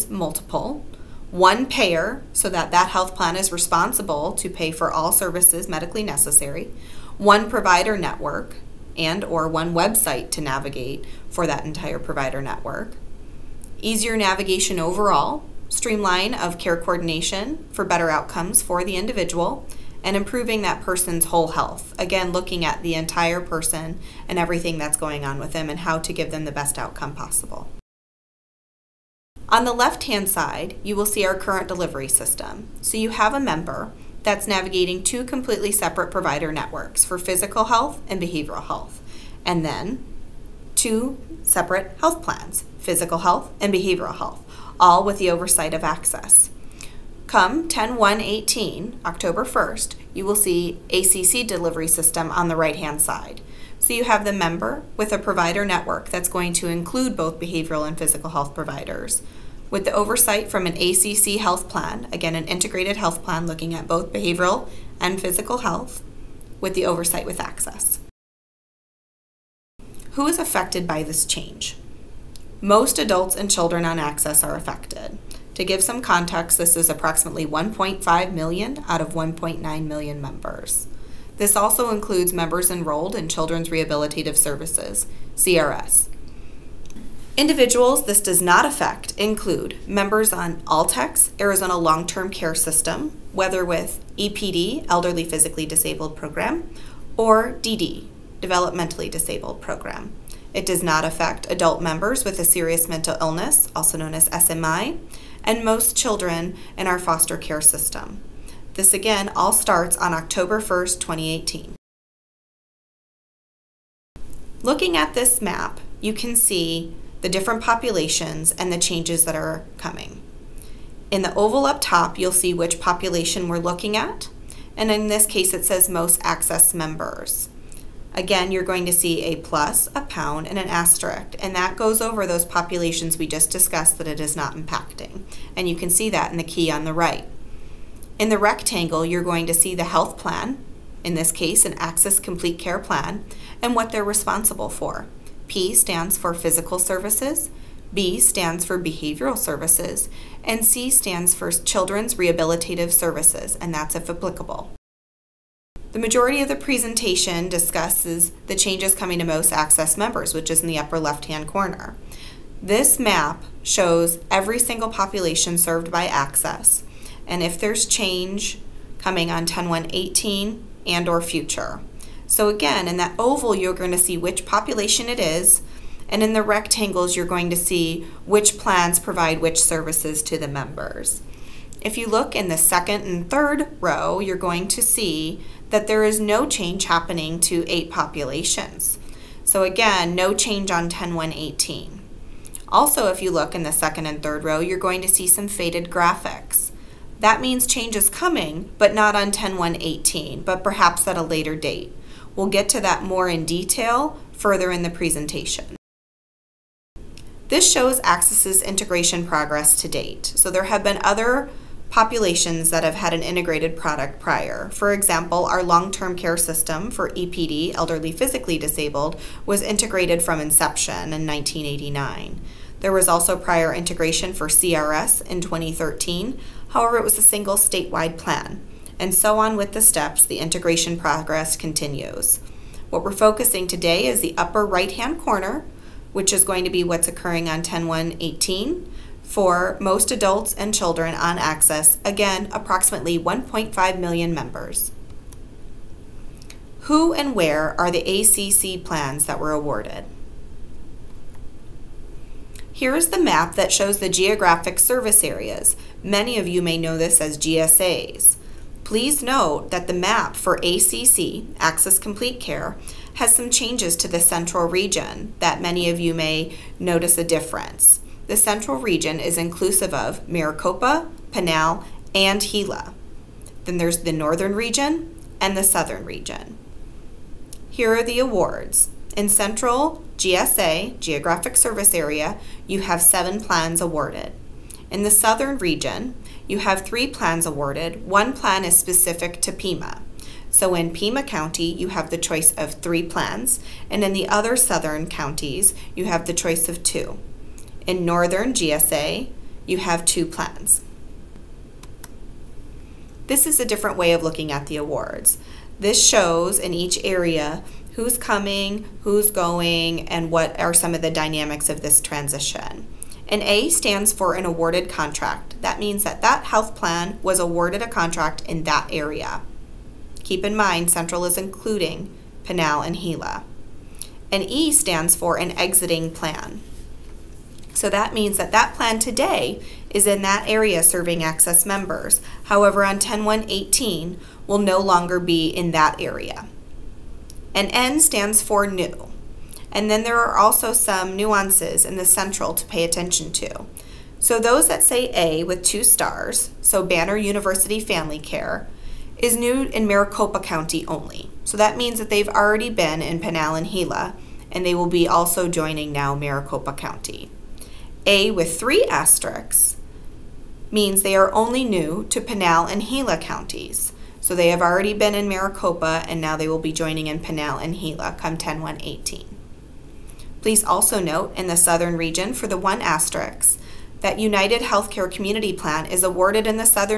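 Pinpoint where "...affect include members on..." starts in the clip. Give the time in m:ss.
1:28.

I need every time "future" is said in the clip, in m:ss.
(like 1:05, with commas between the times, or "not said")
2:51.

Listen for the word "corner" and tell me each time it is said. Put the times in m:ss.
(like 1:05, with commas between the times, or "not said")
2:41, 3:55.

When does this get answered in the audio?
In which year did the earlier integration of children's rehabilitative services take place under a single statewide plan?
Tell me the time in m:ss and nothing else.
3:45.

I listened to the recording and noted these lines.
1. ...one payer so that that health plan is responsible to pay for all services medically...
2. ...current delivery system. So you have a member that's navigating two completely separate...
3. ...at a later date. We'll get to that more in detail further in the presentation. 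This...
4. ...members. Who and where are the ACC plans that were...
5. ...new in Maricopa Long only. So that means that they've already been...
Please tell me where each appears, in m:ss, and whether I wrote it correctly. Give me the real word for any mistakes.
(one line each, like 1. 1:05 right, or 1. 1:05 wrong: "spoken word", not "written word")
1. 0:01 right
2. 0:31 right
3. 3:21 right
4. 4:04 right
5. 5:49 wrong: "County", not "Long".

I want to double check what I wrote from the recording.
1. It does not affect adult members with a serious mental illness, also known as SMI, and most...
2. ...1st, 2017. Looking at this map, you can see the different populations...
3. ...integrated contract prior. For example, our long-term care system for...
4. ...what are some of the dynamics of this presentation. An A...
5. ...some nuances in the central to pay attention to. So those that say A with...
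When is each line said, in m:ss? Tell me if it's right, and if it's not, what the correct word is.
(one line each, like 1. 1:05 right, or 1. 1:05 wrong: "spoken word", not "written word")
1. 1:40 right
2. 1:50 wrong: "2018", not "2017"
3. 3:33 wrong: "product", not "contract"
4. 5:10 wrong: "transition", not "presentation"
5. 5:40 right.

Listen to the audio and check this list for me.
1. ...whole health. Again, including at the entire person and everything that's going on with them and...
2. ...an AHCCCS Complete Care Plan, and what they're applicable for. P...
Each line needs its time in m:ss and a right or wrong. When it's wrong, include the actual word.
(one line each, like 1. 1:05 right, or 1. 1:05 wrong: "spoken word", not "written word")
1. 0:21 wrong: "looking", not "including"
2. 2:21 wrong: "responsible", not "applicable".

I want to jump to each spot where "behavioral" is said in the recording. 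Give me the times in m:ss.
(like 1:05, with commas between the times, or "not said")
0:38, 0:43, 0:57, 1:04, 2:28.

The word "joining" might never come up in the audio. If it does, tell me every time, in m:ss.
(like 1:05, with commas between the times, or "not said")
5:55, 6:06.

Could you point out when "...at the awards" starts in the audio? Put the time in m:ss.
5:04.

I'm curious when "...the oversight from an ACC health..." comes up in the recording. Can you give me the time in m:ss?
0:59.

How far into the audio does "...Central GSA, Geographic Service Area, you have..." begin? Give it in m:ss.
4:39.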